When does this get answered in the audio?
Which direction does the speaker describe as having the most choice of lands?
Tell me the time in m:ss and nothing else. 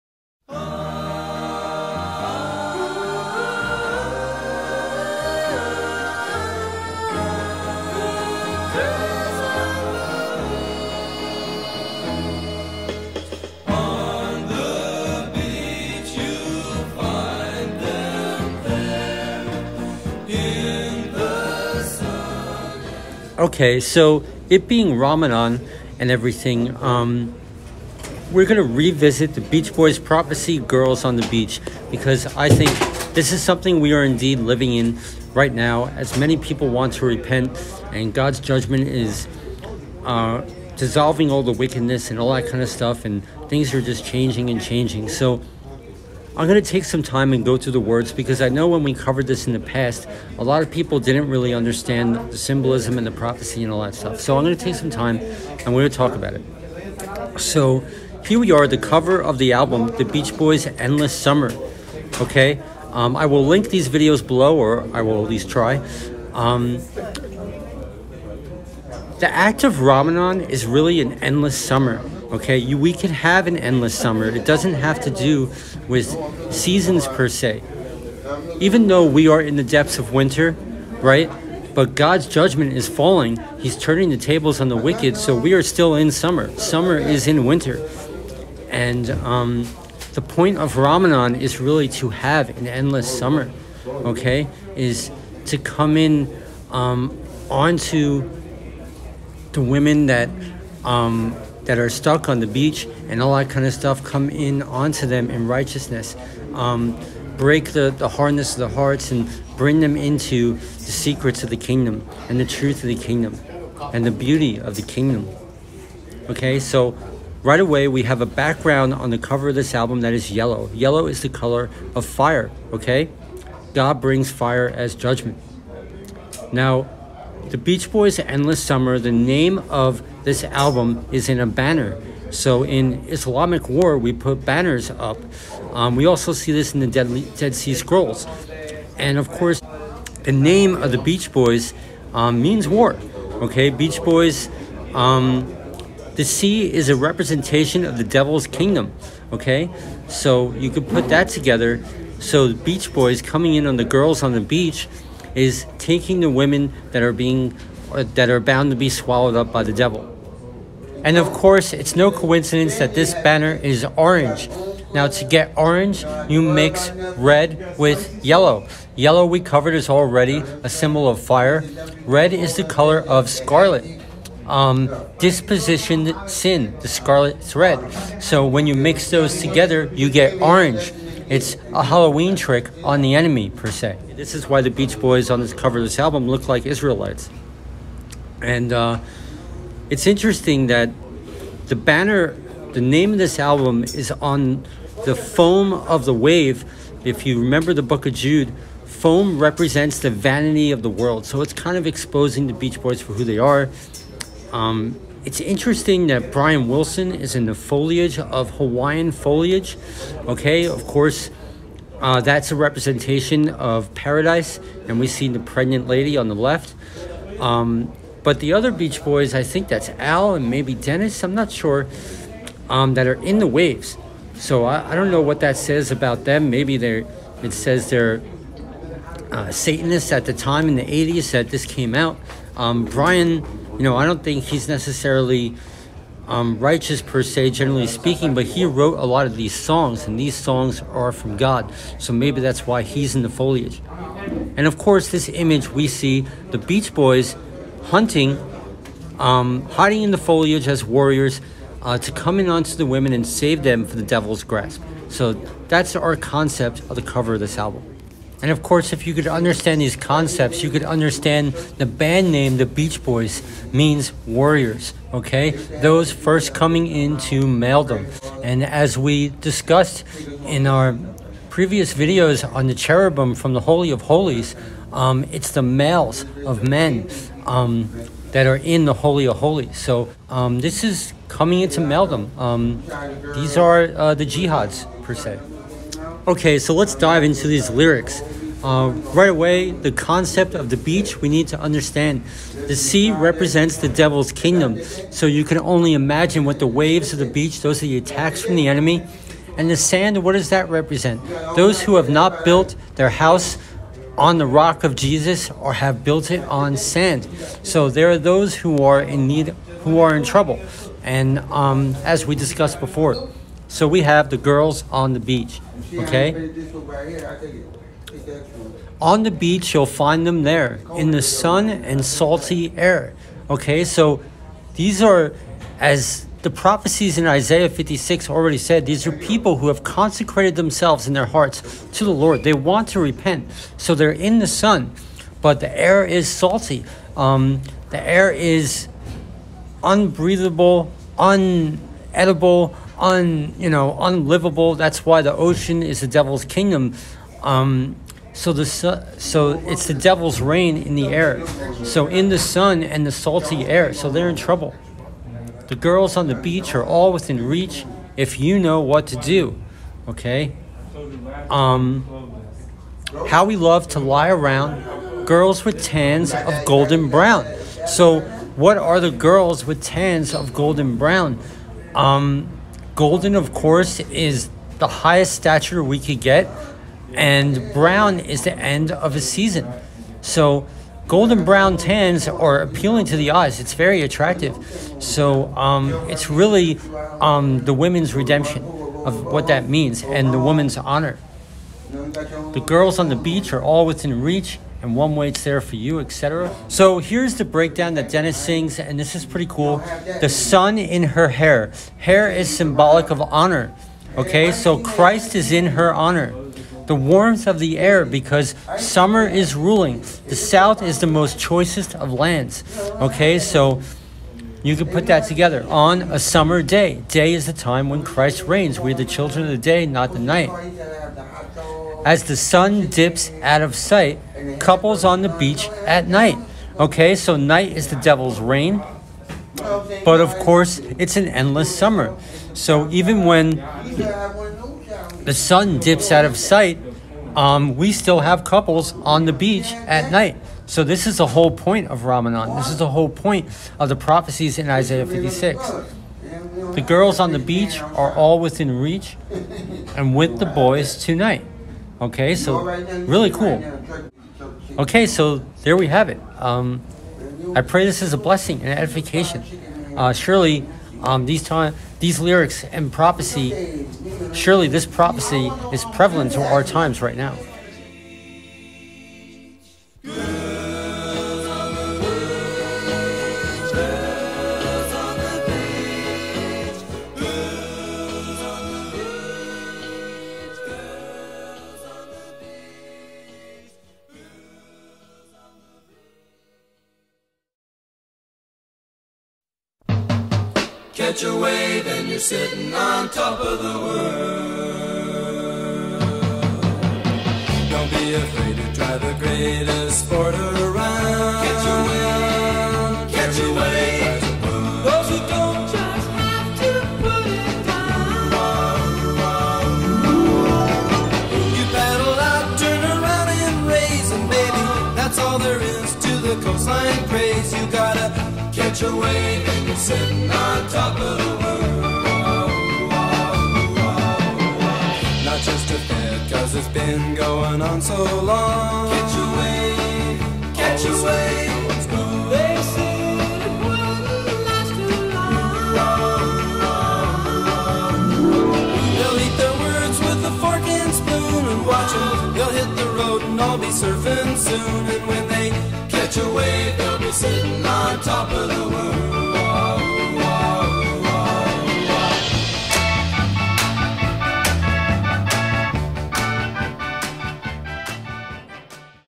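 6:50.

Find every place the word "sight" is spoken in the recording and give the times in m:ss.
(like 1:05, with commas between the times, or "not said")
7:03, 7:16.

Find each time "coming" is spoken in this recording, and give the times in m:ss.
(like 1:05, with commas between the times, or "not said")
2:33, 4:26, 4:41.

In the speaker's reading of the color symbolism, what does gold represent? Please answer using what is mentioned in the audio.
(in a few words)
The highest stature.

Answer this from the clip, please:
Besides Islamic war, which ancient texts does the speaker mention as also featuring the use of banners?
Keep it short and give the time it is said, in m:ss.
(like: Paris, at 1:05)
Dead Sea Scrolls, at 2:17.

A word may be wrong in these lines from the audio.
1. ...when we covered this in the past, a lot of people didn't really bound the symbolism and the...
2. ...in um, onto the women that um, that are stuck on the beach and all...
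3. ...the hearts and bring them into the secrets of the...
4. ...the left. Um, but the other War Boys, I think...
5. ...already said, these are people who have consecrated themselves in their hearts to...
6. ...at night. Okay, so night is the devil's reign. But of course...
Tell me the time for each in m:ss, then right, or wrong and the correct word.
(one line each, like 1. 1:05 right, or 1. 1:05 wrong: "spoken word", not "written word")
1. 0:48 wrong: "understand", not "bound"
2. 1:35 right
3. 1:48 right
4. 3:36 wrong: "Beach", not "War"
5. 5:28 right
6. 7:05 right.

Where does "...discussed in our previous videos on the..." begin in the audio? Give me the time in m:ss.
4:29.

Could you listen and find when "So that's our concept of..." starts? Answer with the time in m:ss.
4:15.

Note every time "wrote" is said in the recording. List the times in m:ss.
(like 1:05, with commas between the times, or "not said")
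3:58.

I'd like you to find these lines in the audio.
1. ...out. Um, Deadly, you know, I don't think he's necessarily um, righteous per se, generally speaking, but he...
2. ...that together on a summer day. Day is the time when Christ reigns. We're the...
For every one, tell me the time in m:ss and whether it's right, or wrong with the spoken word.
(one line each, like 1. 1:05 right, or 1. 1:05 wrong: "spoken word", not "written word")
1. 3:51 wrong: "Brian", not "Deadly"
2. 6:55 right.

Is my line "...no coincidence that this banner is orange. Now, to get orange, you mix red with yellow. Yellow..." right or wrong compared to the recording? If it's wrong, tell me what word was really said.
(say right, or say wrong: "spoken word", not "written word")
right.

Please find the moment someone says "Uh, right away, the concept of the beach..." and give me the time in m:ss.
4:48.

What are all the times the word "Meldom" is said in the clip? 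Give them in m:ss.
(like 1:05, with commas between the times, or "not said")
4:41.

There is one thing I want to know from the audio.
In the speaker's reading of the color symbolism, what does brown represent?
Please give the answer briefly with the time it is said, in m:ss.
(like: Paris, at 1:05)
The end of a season, at 6:18.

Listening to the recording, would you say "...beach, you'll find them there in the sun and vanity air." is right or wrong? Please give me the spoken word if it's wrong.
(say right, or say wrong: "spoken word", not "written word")
wrong: "salty", not "vanity".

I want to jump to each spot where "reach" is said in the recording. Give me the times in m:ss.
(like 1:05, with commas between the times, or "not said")
5:57, 6:34, 7:28.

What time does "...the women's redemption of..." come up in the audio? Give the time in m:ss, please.
6:27.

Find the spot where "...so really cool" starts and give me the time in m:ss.
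7:32.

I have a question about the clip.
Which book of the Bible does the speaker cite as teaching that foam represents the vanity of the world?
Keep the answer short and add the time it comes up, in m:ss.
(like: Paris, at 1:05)
Book of Jude, at 3:17.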